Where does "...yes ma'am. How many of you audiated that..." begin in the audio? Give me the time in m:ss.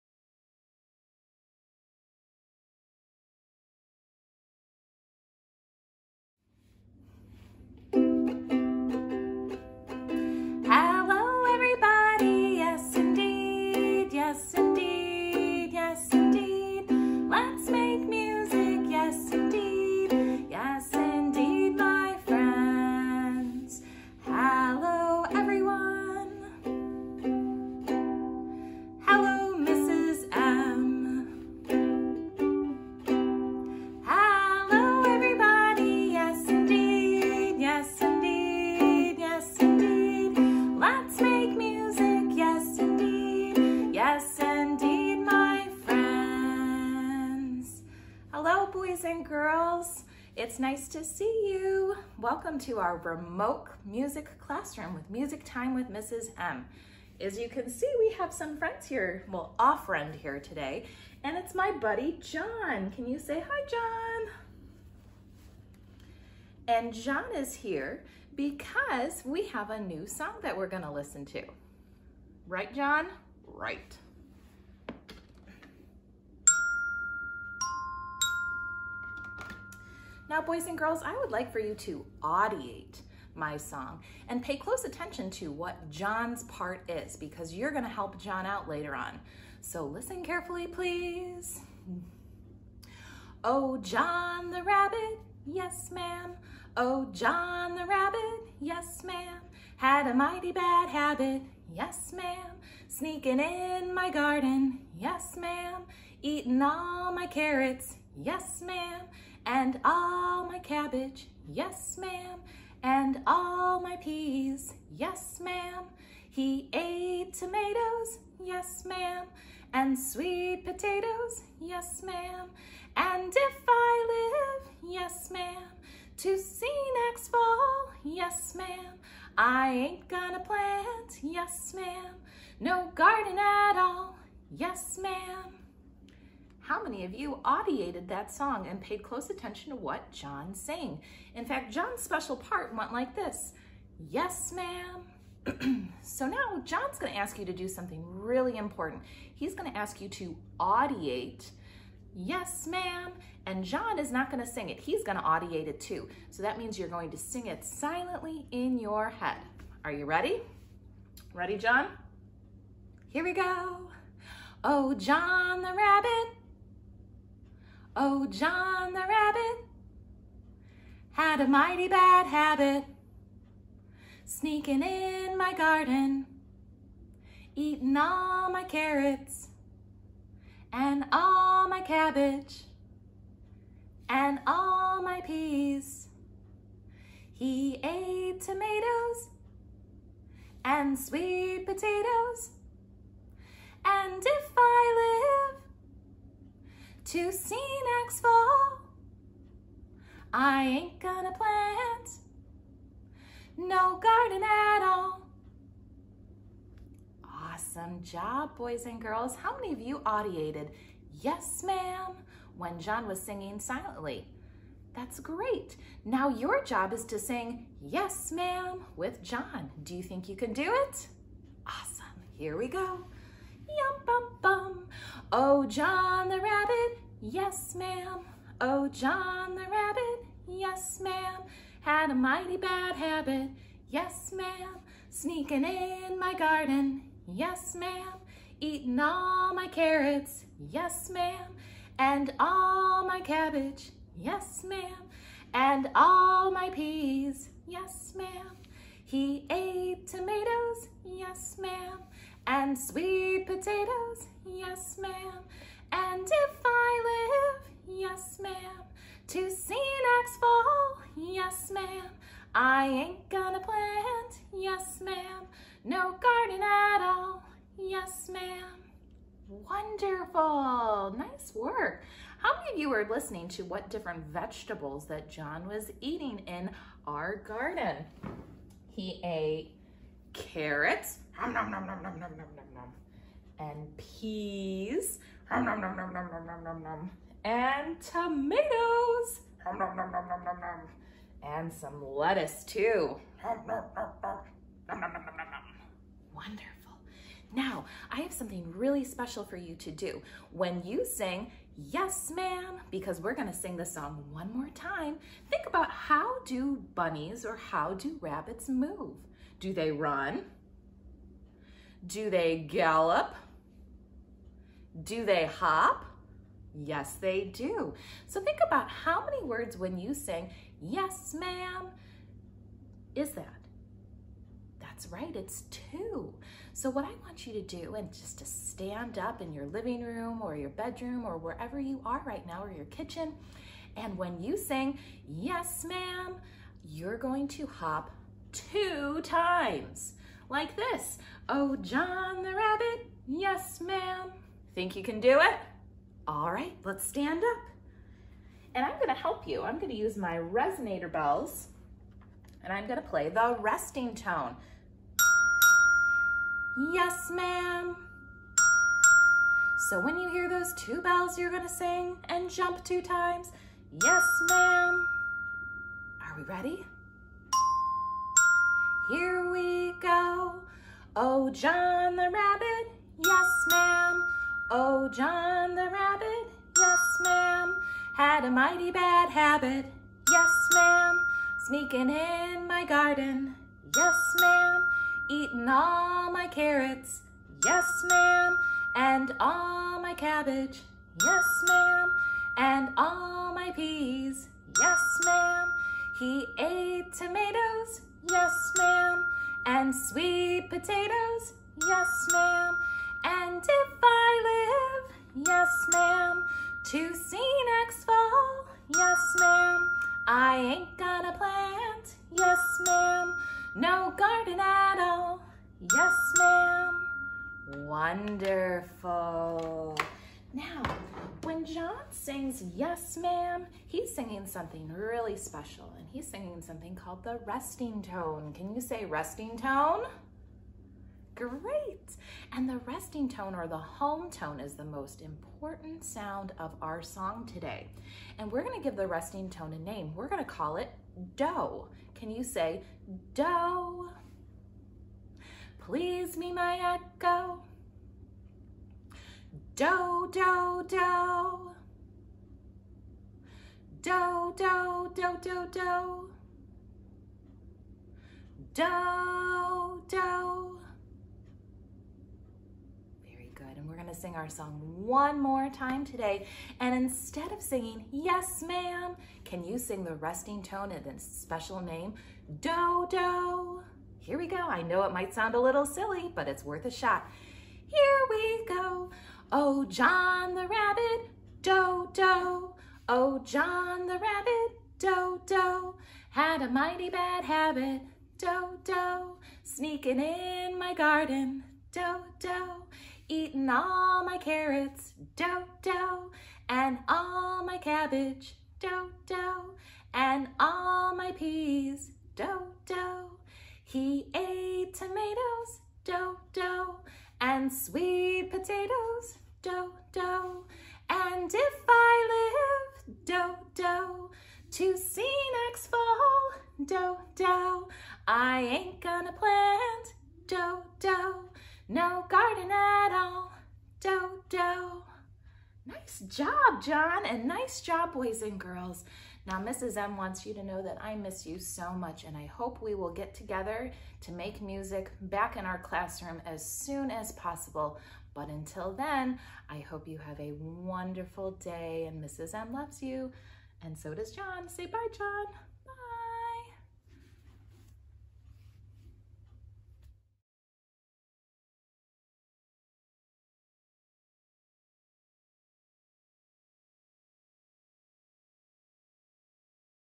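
2:14.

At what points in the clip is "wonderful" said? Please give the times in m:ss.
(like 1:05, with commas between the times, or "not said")
4:29, 4:56, 6:57, 9:00.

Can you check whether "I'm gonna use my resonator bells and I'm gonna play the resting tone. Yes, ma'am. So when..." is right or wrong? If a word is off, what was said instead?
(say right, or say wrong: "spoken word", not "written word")
right.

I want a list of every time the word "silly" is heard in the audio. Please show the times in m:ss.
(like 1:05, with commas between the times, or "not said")
7:55.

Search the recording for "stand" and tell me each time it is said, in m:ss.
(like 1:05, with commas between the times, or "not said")
5:28, 5:47.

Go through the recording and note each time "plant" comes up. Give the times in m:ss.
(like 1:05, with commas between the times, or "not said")
2:10, 3:21, 4:23, 6:51, 8:39.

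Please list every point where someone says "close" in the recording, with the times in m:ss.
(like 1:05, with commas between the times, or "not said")
1:24, 2:19.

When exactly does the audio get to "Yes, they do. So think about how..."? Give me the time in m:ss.
5:16.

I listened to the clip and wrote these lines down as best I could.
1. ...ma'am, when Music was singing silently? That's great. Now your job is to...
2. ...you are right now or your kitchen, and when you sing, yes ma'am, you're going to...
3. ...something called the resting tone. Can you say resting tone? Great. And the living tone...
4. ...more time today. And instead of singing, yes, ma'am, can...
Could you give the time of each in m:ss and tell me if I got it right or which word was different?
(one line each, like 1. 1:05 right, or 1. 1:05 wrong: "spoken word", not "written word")
1. 3:31 wrong: "John", not "Music"
2. 5:31 right
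3. 7:06 wrong: "resting", not "living"
4. 7:45 right.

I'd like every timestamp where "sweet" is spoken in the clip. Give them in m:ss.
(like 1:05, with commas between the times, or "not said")
1:59, 3:10, 4:12, 6:39, 8:27.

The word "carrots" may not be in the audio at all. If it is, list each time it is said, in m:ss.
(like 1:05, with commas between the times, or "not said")
1:47, 2:58, 3:59, 4:40, 6:26, 8:14.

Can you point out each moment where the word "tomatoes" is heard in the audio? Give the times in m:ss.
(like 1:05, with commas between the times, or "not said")
1:57, 3:08, 4:10, 4:48, 6:37, 8:24.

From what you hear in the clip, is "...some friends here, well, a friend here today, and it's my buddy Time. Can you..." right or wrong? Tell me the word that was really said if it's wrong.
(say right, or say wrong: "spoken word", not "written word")
wrong: "John", not "Time".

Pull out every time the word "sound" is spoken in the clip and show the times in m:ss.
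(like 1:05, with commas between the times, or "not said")
7:16, 7:55.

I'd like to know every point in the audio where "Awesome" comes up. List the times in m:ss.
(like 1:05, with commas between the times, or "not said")
3:27, 3:41.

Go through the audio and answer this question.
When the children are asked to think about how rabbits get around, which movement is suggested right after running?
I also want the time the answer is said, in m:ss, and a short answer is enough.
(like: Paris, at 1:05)
gallop, at 5:12.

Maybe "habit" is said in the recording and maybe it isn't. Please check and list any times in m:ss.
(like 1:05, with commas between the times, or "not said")
1:40, 2:52, 3:52, 6:19, 8:07.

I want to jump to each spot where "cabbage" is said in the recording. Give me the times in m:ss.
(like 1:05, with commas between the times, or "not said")
1:50, 3:01, 4:03, 6:30, 8:17.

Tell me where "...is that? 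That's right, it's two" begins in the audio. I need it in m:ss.
5:23.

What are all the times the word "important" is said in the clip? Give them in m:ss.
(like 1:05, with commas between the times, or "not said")
2:28, 7:15.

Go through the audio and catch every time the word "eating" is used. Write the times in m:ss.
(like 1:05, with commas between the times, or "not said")
1:46, 2:57, 3:58, 4:35, 6:25, 8:13.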